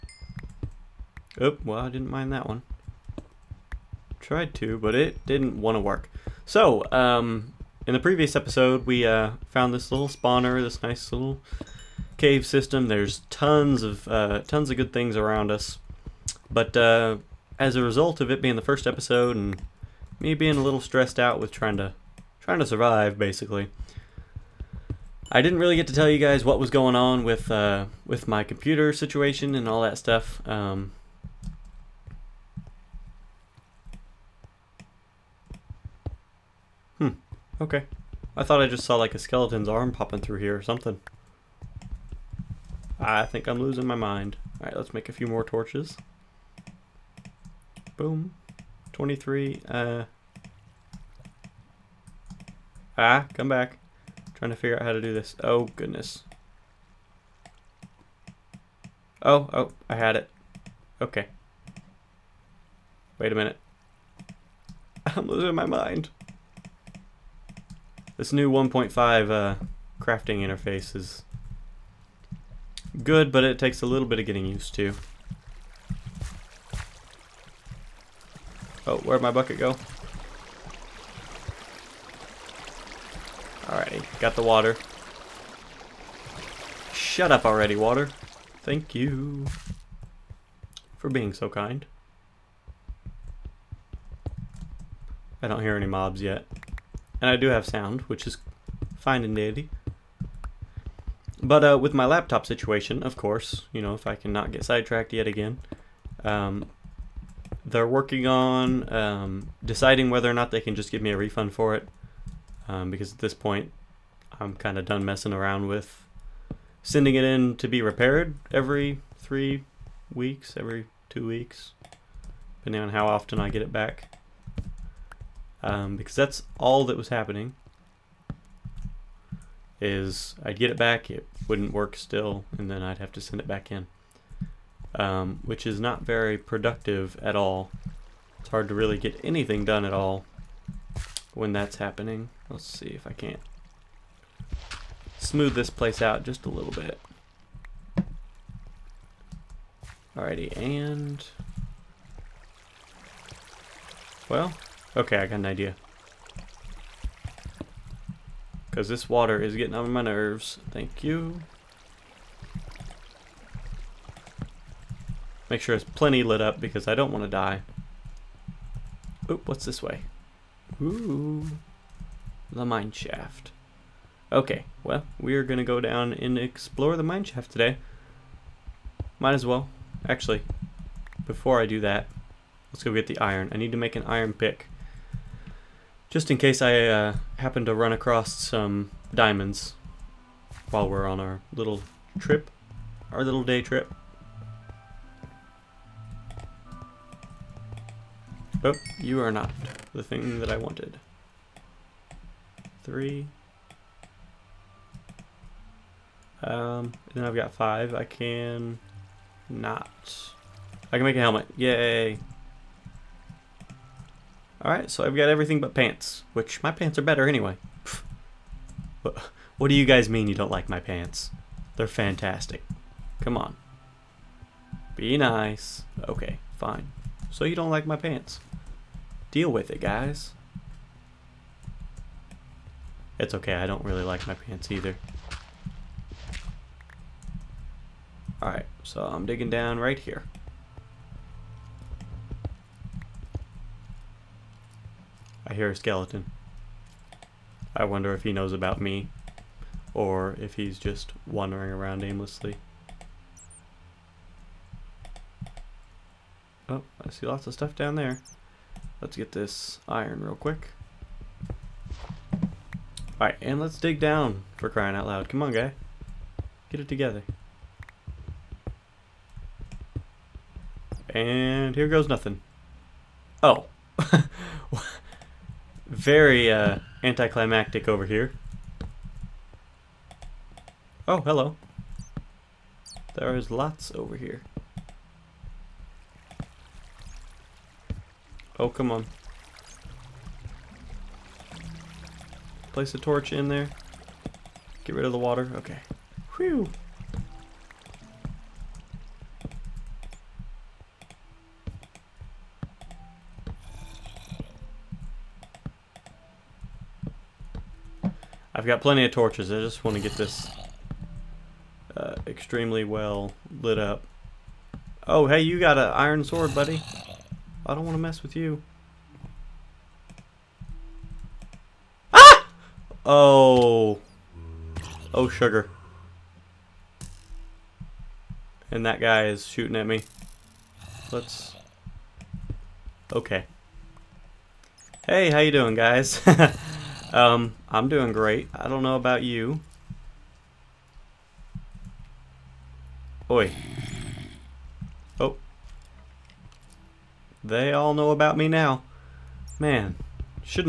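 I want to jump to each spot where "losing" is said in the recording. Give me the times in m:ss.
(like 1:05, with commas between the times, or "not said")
0:43, 1:05.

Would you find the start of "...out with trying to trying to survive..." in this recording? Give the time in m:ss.
0:21.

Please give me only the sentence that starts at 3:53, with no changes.
It's okay, I don't really like my pants either.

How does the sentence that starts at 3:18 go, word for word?
Oh, you are not the thing that I wanted.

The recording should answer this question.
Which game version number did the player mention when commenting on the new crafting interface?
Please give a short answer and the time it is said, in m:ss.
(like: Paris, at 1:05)
1.5, at 1:08.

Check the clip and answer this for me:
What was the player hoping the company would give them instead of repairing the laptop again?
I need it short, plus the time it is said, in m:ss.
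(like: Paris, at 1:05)
A refund, at 1:51.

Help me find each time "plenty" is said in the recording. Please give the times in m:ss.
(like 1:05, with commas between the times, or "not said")
2:45, 5:08.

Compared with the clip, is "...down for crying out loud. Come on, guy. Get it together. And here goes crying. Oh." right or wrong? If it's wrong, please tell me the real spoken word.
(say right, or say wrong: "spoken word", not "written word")
wrong: "nothing", not "crying".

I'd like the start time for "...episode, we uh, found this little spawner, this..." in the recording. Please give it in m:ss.
0:08.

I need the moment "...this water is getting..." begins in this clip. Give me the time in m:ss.
2:38.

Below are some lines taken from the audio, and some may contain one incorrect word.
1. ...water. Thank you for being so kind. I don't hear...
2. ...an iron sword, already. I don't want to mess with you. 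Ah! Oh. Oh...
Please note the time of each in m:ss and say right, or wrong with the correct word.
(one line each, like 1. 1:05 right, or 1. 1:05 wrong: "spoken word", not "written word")
1. 1:27 right
2. 5:15 wrong: "buddy", not "already".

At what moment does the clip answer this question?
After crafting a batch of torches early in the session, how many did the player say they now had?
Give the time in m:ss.
0:48.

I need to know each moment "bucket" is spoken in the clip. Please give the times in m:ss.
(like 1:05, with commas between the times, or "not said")
1:19.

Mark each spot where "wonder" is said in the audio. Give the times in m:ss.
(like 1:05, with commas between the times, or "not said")
4:07.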